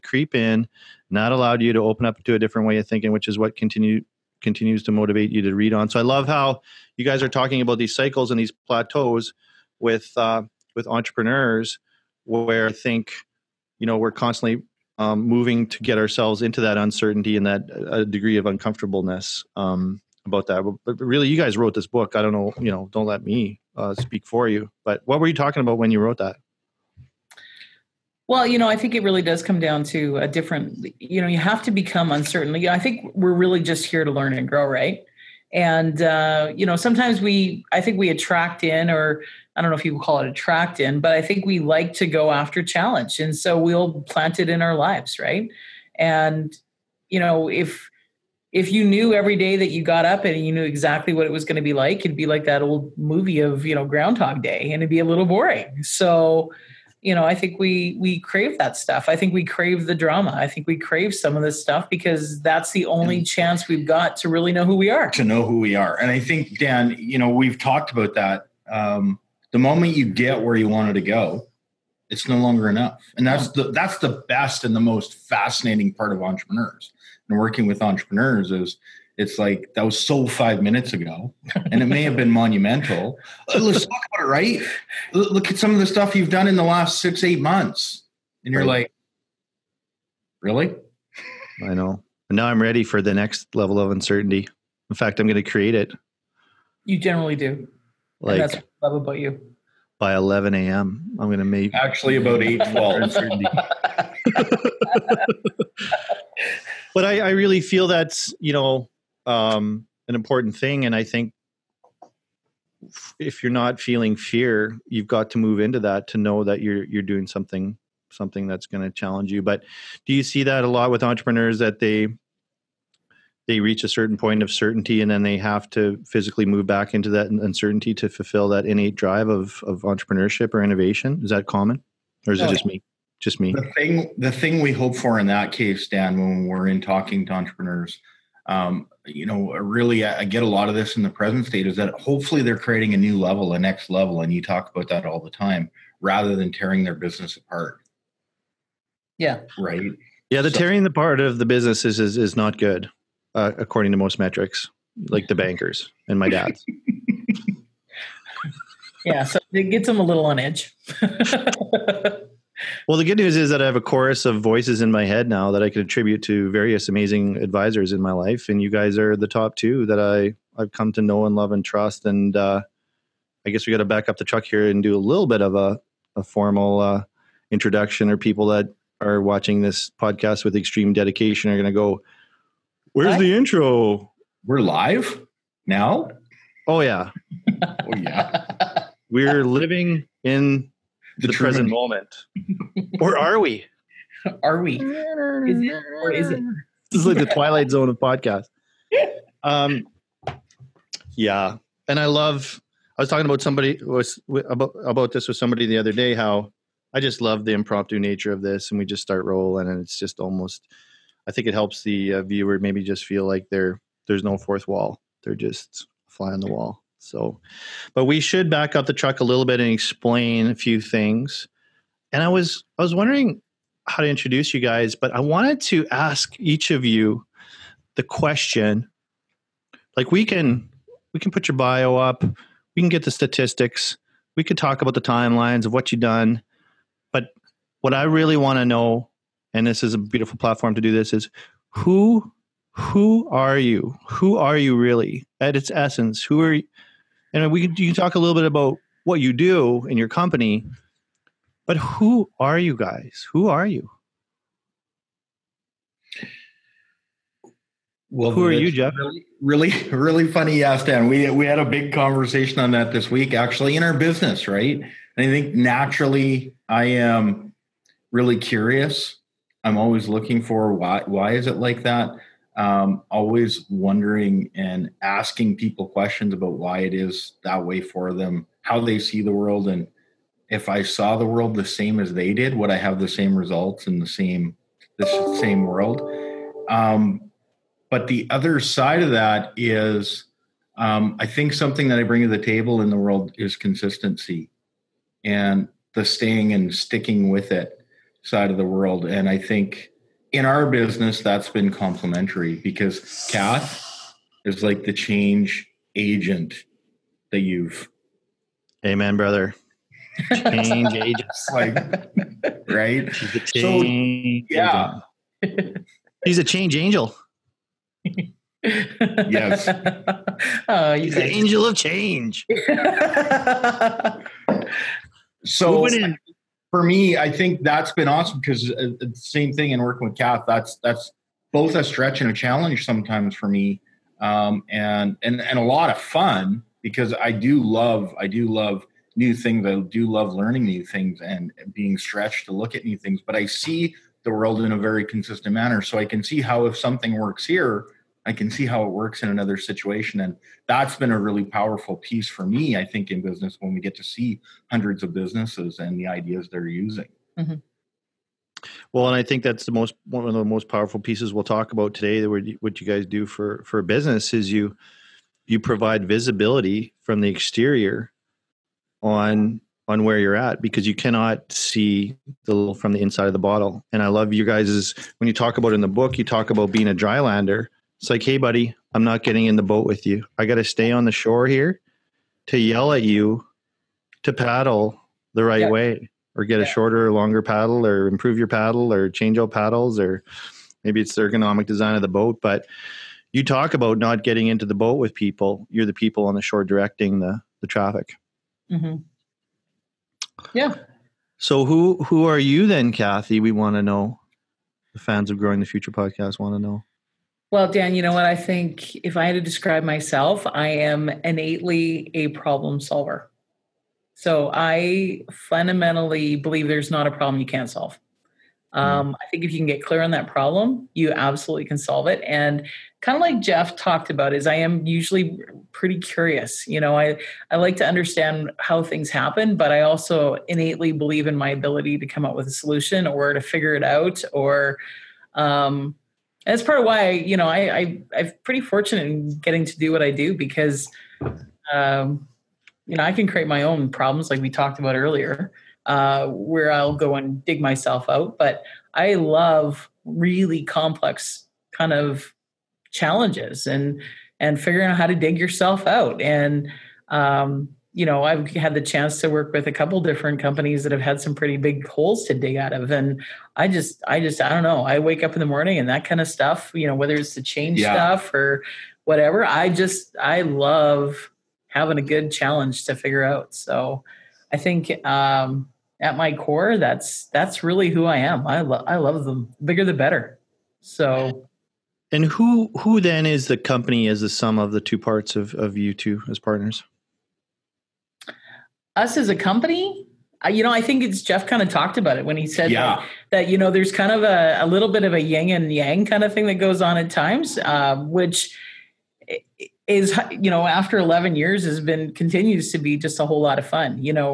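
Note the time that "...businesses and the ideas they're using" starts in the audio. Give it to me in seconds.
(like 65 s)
355 s.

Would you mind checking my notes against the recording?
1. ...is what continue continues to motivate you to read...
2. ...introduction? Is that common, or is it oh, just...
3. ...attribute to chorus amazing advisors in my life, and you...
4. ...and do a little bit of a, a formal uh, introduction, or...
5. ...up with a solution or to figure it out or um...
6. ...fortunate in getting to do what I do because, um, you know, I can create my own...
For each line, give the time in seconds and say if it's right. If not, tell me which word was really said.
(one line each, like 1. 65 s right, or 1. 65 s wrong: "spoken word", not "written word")
1. 3 s right
2. 130 s wrong: "innovation", not "introduction"
3. 165 s wrong: "various", not "chorus"
4. 174 s right
5. 432 s right
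6. 438 s right.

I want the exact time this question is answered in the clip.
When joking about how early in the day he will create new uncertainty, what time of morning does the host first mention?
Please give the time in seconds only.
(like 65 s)
100 s.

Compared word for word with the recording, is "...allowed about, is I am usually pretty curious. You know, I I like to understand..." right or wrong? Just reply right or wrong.
wrong.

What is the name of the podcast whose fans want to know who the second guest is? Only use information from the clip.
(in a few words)
Growing the Future.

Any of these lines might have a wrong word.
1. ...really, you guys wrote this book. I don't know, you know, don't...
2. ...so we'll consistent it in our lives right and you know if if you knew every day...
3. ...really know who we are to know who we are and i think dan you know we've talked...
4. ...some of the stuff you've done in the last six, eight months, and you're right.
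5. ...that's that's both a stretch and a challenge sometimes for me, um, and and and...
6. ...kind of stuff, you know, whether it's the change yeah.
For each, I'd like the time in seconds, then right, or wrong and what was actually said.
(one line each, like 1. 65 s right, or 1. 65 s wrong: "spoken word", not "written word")
1. 20 s right
2. 43 s wrong: "plant", not "consistent"
3. 64 s right
4. 85 s right
5. 330 s right
6. 466 s right.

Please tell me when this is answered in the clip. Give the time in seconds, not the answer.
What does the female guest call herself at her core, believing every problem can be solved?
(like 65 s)
412 s.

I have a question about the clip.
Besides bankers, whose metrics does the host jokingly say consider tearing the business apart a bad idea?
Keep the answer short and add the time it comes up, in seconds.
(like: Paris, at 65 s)
my dad's, at 156 s.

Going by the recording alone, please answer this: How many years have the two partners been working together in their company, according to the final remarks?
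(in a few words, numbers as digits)
11.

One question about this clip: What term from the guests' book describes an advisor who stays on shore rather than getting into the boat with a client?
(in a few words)
drylander.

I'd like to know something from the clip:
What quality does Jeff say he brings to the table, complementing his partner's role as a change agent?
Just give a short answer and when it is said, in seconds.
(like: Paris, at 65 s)
consistency, at 293 s.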